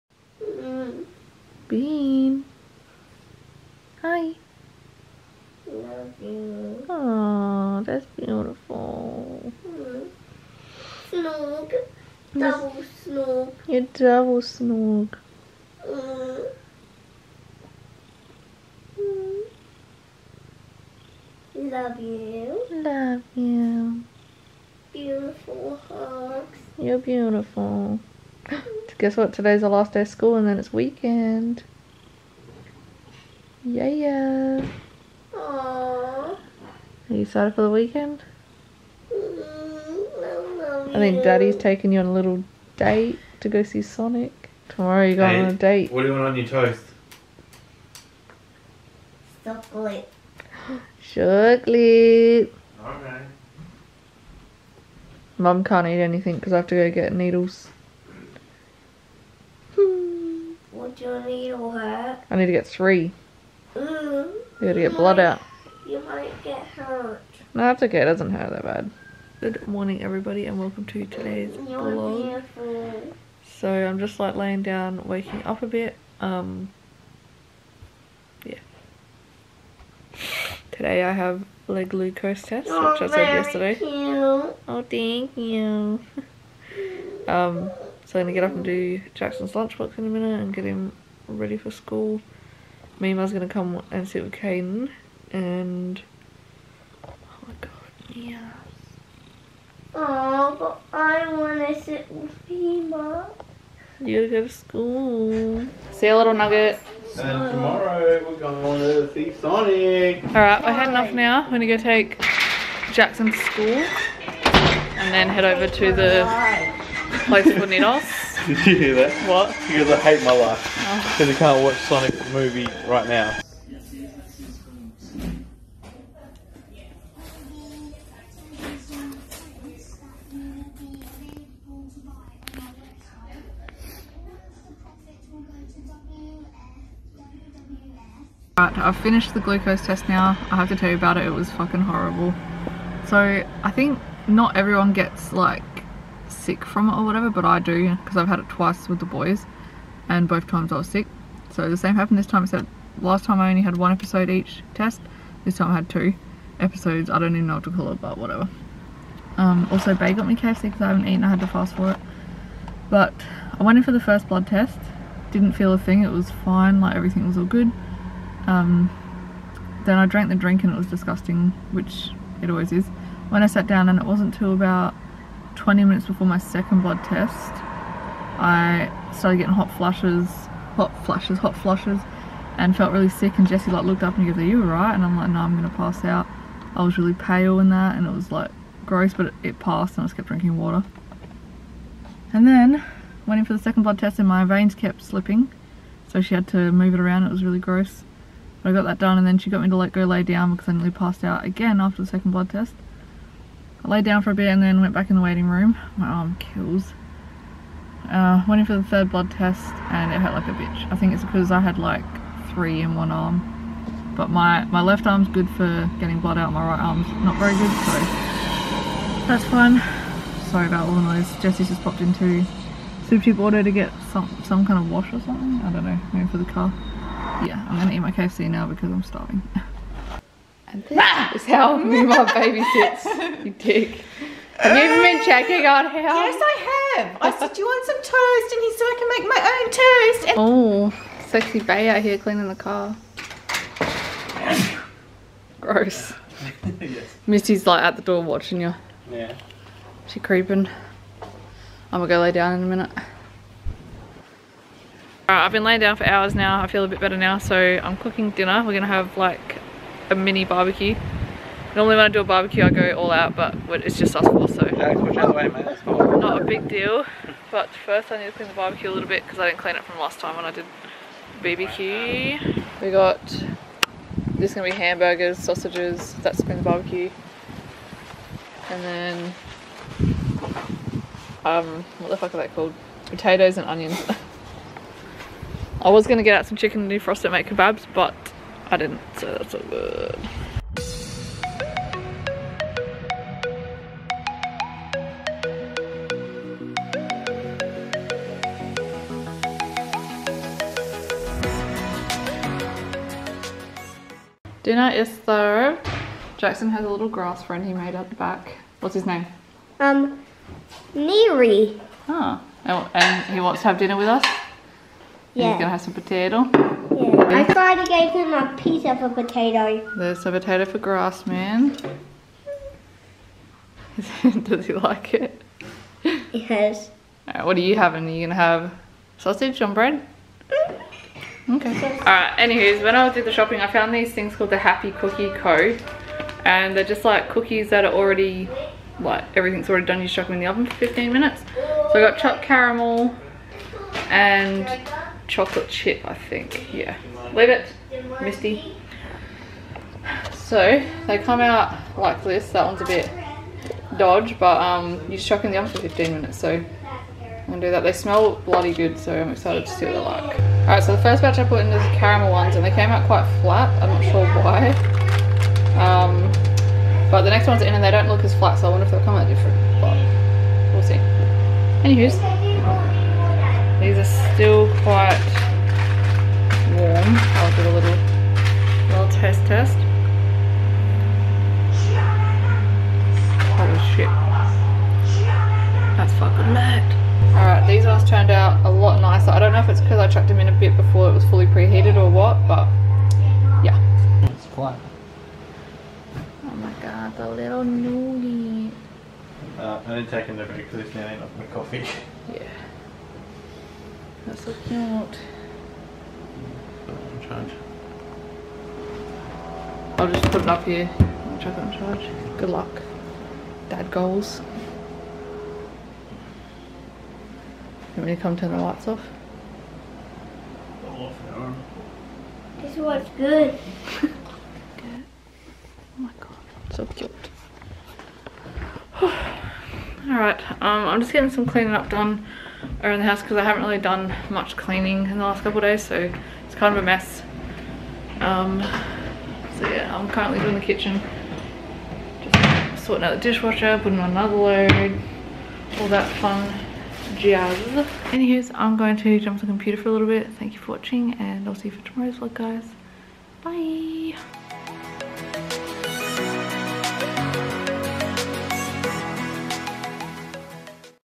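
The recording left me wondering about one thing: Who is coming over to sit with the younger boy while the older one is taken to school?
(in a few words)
Meema.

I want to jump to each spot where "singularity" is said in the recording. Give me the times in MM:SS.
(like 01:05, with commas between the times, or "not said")
not said.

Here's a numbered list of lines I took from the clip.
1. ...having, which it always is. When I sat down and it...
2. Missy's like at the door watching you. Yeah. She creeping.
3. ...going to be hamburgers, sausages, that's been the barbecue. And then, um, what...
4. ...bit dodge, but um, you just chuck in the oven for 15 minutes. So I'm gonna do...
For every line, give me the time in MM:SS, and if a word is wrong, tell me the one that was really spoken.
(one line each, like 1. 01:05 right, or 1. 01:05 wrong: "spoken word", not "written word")
1. 02:50 wrong: "disgusting", not "having"
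2. 04:07 right
3. 04:34 right
4. 05:52 right.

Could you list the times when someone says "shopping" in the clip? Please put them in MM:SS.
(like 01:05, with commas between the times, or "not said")
05:33.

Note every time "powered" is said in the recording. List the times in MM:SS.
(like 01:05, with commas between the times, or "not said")
not said.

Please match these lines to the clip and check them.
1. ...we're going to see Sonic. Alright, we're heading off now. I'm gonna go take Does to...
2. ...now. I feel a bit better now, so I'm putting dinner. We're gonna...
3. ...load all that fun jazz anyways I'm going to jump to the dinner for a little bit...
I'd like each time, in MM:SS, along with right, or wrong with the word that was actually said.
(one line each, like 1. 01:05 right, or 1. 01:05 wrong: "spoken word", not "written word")
1. 01:48 wrong: "Jackson", not "Does"
2. 04:16 wrong: "cooking", not "putting"
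3. 07:24 wrong: "computer", not "dinner".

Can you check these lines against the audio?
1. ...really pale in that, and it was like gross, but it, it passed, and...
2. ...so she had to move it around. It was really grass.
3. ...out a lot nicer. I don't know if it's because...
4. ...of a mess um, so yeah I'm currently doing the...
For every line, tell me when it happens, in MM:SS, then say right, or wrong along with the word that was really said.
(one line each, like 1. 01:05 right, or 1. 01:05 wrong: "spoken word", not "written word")
1. 03:06 right
2. 03:16 wrong: "gross", not "grass"
3. 06:28 right
4. 07:16 right.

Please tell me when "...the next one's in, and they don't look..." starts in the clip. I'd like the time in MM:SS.
06:07.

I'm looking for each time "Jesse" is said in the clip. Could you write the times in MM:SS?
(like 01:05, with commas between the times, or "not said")
03:03, 03:41.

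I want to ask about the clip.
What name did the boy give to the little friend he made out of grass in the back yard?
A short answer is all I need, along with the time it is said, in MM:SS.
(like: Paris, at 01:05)
Neary, at 05:10.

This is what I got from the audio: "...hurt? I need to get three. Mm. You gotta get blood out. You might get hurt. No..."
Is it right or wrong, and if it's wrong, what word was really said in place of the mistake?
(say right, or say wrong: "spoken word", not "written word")
right.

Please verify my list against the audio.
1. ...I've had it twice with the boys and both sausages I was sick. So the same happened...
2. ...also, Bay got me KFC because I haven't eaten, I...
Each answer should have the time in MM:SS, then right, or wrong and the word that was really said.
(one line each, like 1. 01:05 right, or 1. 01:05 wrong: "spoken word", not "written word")
1. 02:28 wrong: "times", not "sausages"
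2. 02:39 right.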